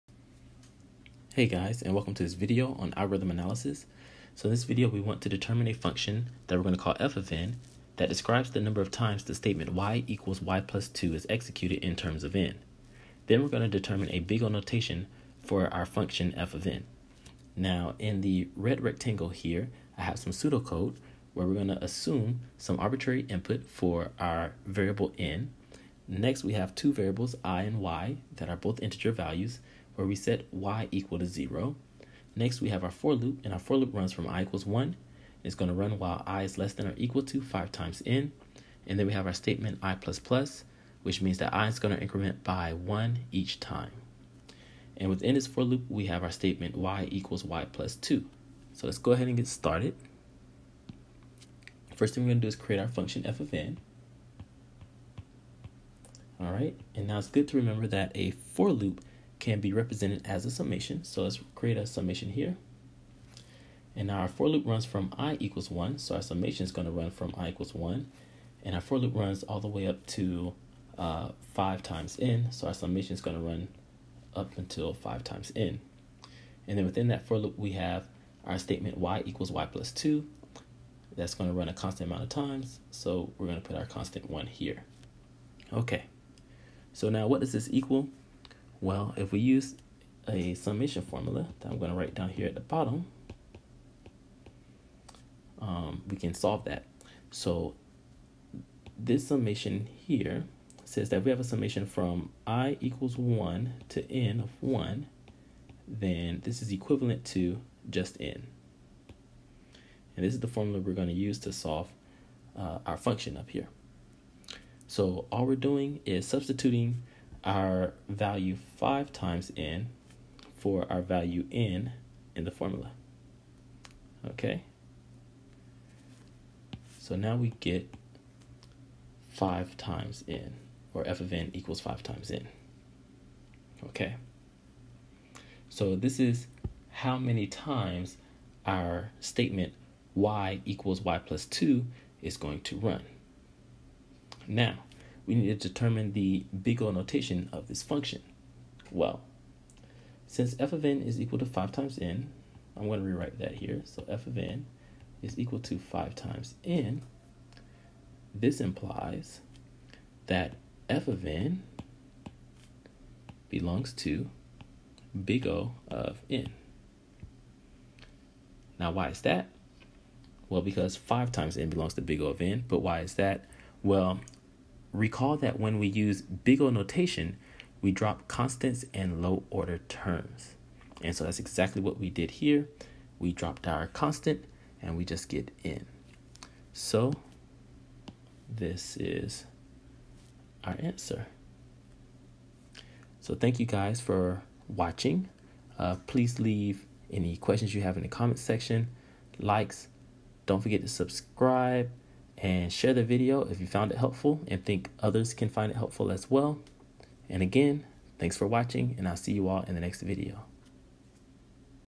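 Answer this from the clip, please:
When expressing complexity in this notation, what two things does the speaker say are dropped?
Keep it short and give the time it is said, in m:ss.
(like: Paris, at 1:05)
Constants and low order terms, at 2:58.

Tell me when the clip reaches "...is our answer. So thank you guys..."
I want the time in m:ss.
3:08.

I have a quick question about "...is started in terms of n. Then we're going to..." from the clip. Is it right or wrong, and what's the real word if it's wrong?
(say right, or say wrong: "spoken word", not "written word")
wrong: "executed", not "started".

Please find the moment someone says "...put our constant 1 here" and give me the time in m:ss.
1:23.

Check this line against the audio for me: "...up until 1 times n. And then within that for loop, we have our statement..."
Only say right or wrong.
wrong.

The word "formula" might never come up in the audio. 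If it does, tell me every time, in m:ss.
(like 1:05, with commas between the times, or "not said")
1:31, 1:50, 2:02.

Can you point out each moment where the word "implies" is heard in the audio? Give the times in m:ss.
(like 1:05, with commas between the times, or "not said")
2:38.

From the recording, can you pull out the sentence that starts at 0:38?
And then we have our statement i++, which means that i is going to increment by 1 each time.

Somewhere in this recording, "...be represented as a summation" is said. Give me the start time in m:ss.
0:59.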